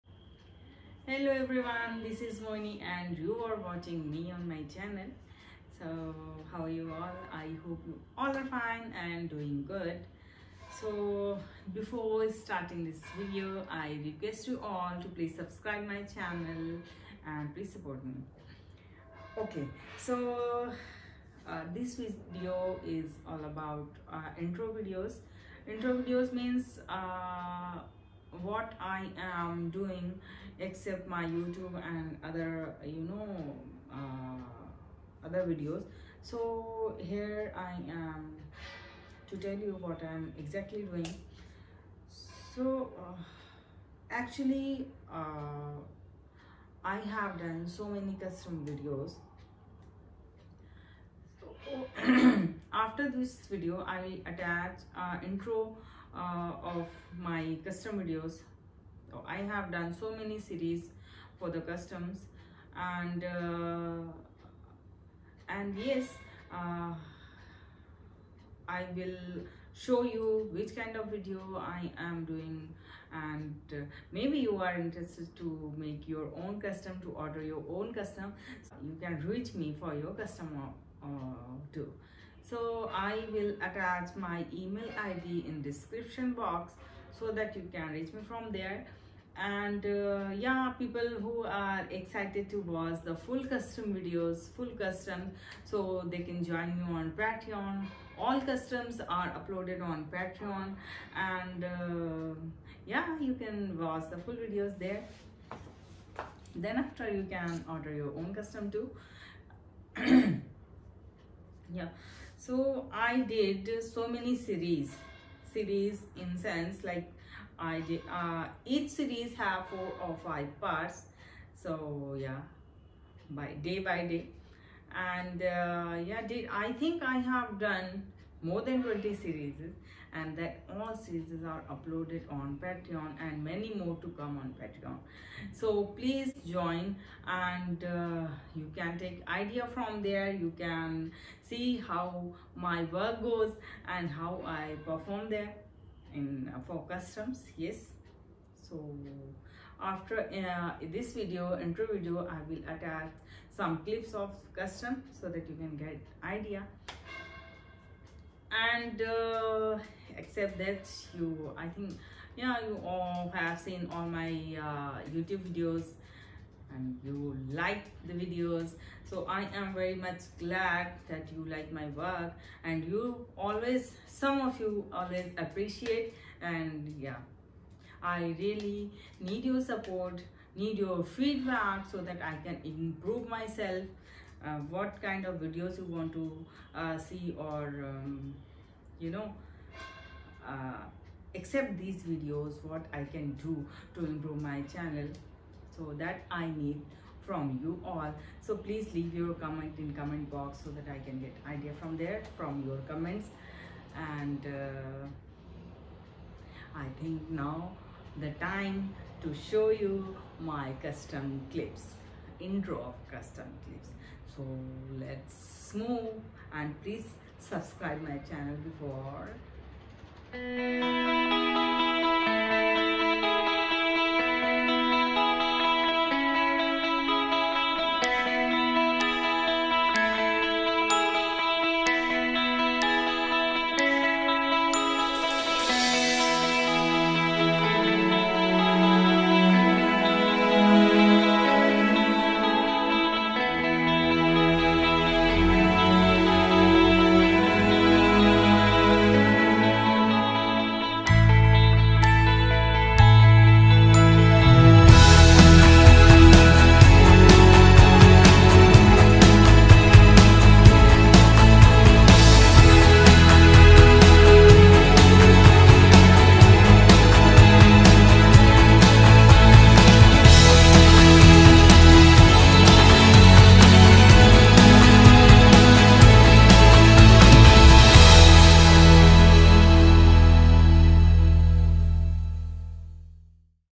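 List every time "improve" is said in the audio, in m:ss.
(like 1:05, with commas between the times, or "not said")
3:02, 3:14.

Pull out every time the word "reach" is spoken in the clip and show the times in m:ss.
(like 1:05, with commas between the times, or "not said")
1:19, 1:27.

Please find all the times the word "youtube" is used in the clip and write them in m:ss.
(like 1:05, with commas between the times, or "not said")
0:31, 2:45.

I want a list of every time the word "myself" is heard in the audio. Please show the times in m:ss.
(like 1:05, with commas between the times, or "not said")
3:03.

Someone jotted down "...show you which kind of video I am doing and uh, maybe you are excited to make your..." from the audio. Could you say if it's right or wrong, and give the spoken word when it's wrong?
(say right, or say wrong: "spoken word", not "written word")
wrong: "interested", not "excited".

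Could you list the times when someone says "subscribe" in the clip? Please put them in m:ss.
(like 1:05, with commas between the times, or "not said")
0:15, 3:37.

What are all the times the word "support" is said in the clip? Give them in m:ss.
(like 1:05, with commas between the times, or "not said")
0:17, 2:59.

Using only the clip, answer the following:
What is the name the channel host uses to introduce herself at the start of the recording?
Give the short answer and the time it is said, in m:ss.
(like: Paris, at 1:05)
Moni, at 0:02.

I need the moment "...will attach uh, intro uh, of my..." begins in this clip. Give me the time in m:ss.
0:54.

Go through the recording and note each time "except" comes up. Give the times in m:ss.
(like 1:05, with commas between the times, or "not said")
0:30, 2:40.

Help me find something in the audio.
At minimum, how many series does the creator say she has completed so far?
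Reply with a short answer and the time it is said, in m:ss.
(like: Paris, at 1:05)
more than 20, at 2:08.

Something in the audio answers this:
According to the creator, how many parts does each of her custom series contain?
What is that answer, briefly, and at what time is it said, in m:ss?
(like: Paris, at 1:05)
4 or 5, at 1:59.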